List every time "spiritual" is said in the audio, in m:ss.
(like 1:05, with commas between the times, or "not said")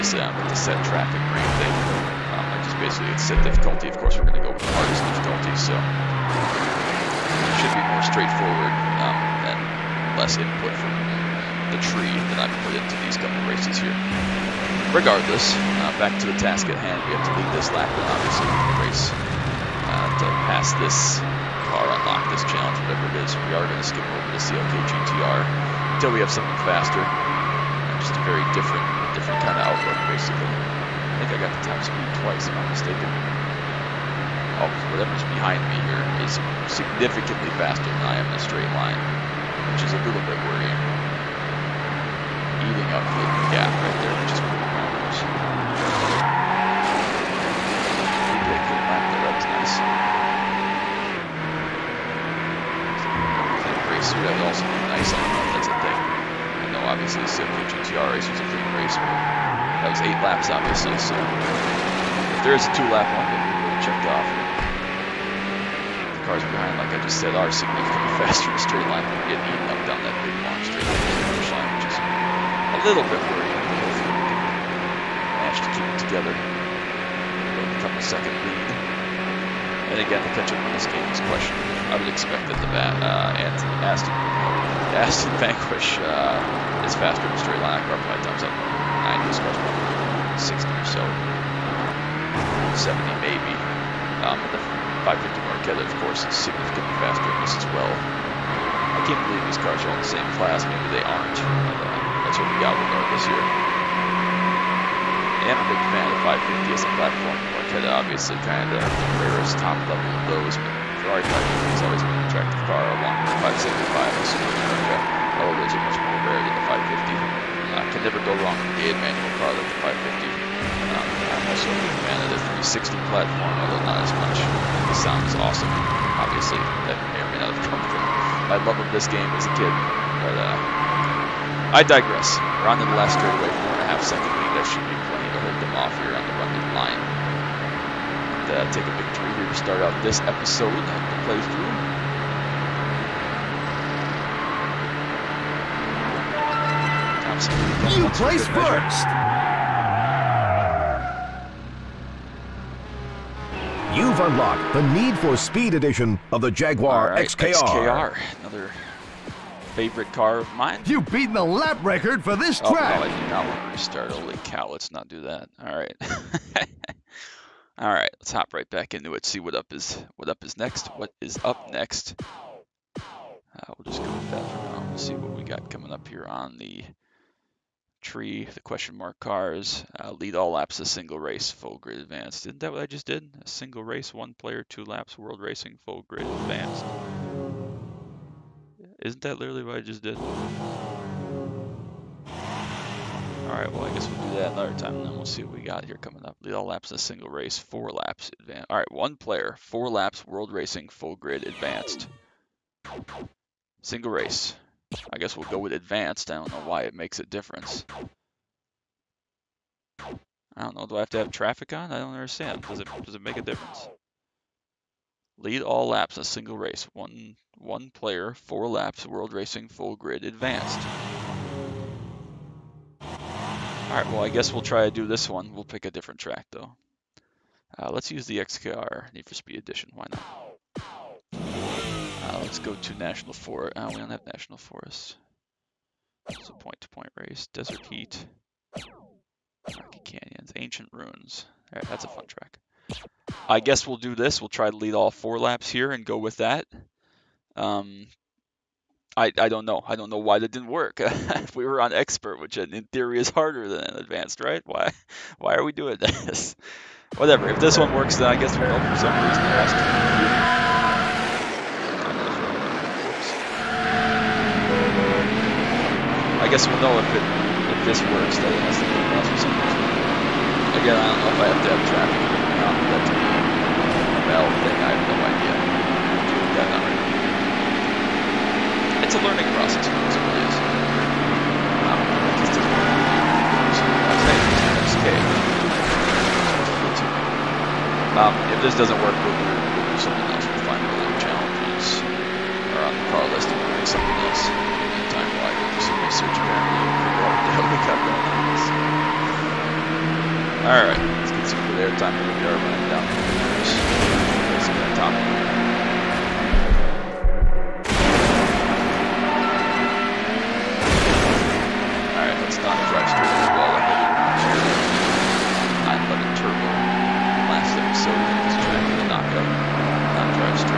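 not said.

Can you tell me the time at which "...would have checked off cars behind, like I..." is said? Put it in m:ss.
1:03.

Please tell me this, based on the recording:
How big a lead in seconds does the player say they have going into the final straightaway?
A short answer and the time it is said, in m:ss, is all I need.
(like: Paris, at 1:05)
4.5 seconds, at 2:13.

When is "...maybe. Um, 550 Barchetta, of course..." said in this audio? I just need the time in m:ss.
1:33.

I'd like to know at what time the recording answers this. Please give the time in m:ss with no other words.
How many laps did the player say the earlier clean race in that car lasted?
1:00.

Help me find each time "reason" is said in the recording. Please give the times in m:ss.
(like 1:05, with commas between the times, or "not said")
4:19, 4:29.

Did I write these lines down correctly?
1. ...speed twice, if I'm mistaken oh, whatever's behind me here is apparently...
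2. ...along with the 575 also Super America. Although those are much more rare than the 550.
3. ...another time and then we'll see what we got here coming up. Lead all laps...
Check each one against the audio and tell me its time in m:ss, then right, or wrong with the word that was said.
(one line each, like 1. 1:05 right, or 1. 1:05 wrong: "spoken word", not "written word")
1. 0:31 wrong: "significantly", not "apparently"
2. 1:52 right
3. 3:14 right.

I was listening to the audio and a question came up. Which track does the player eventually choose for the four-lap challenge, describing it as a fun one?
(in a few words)
Ancient Ruins.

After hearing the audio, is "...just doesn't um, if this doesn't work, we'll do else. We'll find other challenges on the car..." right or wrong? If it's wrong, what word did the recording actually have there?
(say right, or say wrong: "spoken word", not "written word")
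right.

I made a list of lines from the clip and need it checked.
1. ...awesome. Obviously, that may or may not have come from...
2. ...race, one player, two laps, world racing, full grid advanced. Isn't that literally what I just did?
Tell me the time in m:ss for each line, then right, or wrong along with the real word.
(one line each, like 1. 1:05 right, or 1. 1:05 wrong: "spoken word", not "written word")
1. 2:05 right
2. 3:03 right.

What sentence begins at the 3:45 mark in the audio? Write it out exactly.
We'll pick a different track though.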